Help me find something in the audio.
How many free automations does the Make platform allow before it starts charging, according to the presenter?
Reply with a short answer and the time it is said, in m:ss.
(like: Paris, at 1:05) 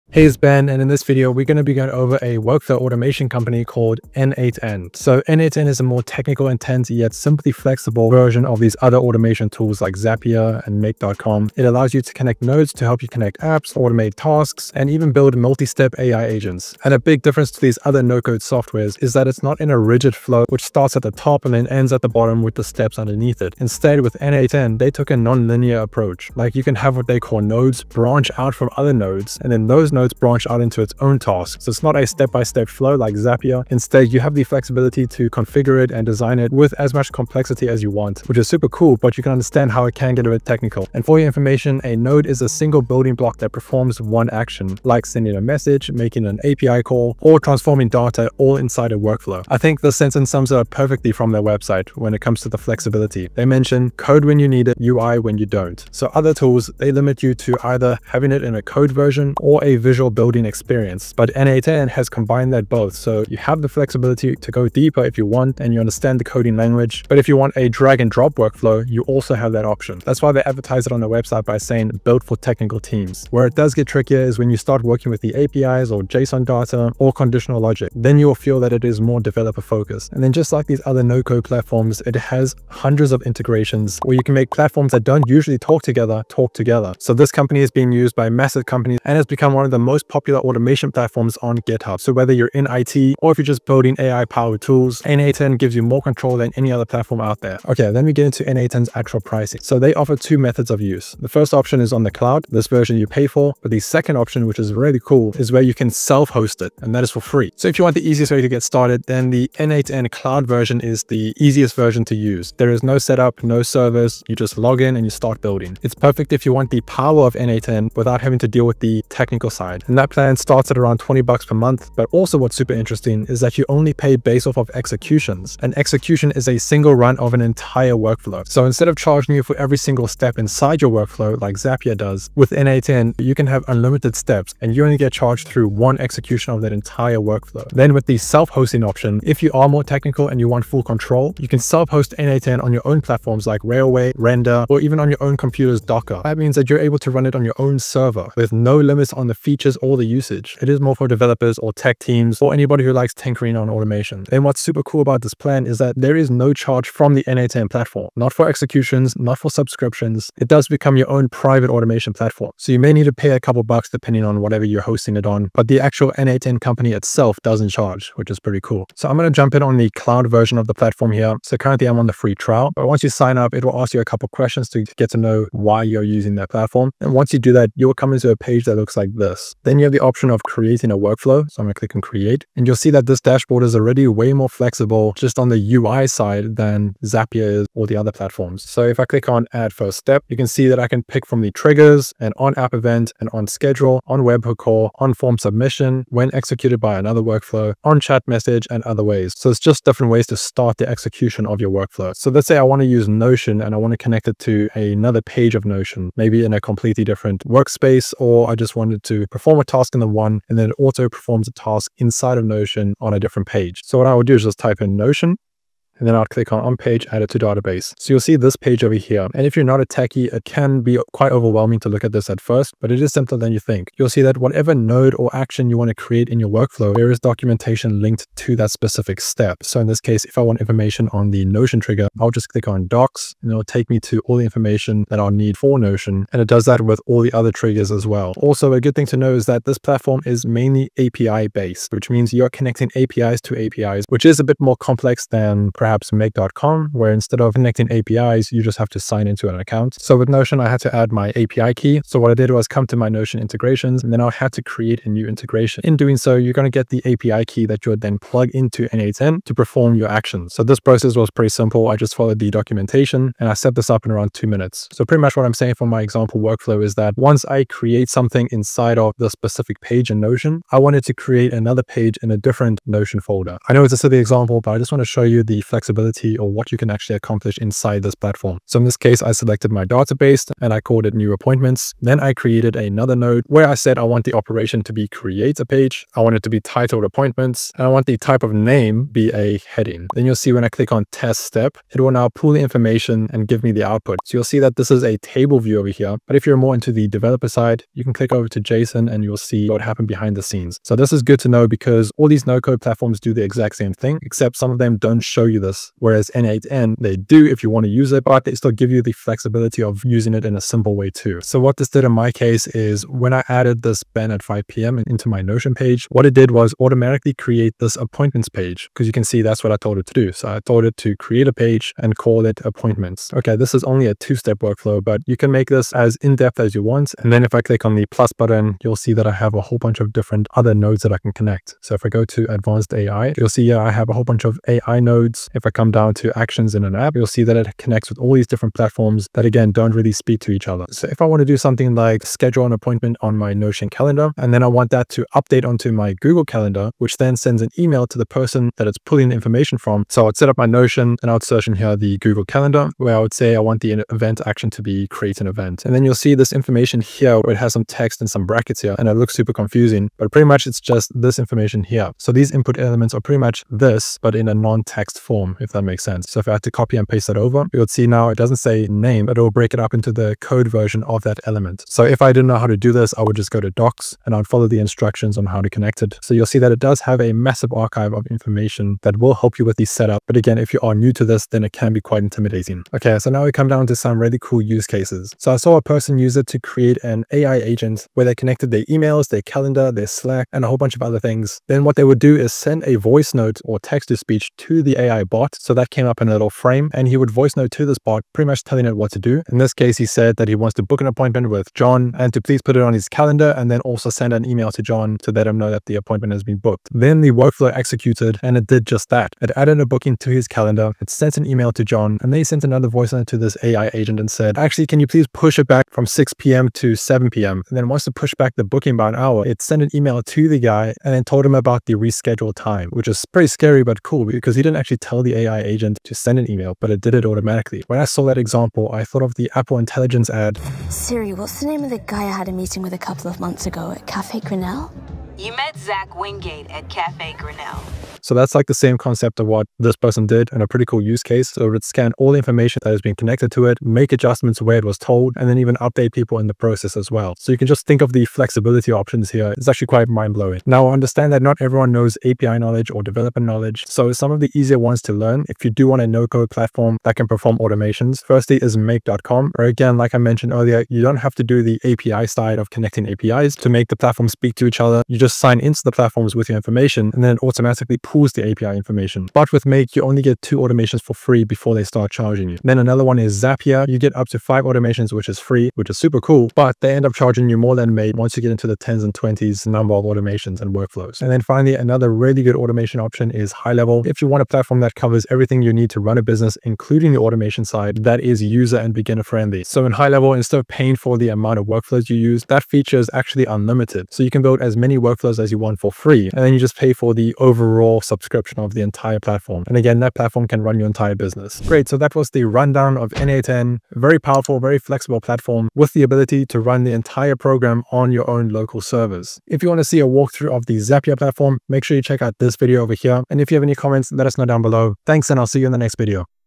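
2, at 7:50.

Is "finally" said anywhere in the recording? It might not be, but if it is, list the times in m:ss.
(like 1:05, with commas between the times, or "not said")
8:01.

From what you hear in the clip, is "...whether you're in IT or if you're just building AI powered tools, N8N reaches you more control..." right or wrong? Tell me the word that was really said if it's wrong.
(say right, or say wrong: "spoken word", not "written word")
wrong: "gives", not "reaches".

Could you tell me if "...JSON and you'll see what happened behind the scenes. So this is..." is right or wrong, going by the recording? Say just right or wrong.
right.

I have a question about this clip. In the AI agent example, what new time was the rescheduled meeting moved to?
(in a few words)
7 p.m.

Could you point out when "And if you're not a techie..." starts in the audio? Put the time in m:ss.
3:39.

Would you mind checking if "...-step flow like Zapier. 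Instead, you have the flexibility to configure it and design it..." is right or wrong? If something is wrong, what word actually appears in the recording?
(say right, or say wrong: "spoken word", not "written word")
right.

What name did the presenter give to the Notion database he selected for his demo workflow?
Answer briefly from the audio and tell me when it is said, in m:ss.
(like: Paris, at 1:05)
new appointments, at 4:41.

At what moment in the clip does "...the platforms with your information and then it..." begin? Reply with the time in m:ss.
7:45.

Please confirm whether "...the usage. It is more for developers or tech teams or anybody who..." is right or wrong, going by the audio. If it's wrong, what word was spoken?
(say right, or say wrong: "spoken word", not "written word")
right.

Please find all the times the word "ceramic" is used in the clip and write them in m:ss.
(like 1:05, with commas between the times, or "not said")
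not said.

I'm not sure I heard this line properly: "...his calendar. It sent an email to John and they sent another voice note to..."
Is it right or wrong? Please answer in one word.
right.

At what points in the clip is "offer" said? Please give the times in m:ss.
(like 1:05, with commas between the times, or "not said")
1:39.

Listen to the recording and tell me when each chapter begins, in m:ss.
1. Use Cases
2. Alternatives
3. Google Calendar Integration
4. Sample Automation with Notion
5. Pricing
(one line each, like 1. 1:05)
1. 6:22
2. 7:30
3. 5:22
4. 2:48
5. 1:37.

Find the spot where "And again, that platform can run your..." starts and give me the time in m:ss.
8:19.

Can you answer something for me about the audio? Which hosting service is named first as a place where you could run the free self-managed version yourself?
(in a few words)
Railway.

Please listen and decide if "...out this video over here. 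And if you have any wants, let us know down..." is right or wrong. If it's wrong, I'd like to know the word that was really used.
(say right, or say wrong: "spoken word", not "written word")
wrong: "comments", not "wants".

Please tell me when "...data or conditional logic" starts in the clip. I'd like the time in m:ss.
1:16.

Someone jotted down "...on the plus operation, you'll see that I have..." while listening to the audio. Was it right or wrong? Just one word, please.
wrong.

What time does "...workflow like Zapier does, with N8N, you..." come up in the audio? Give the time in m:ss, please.
2:10.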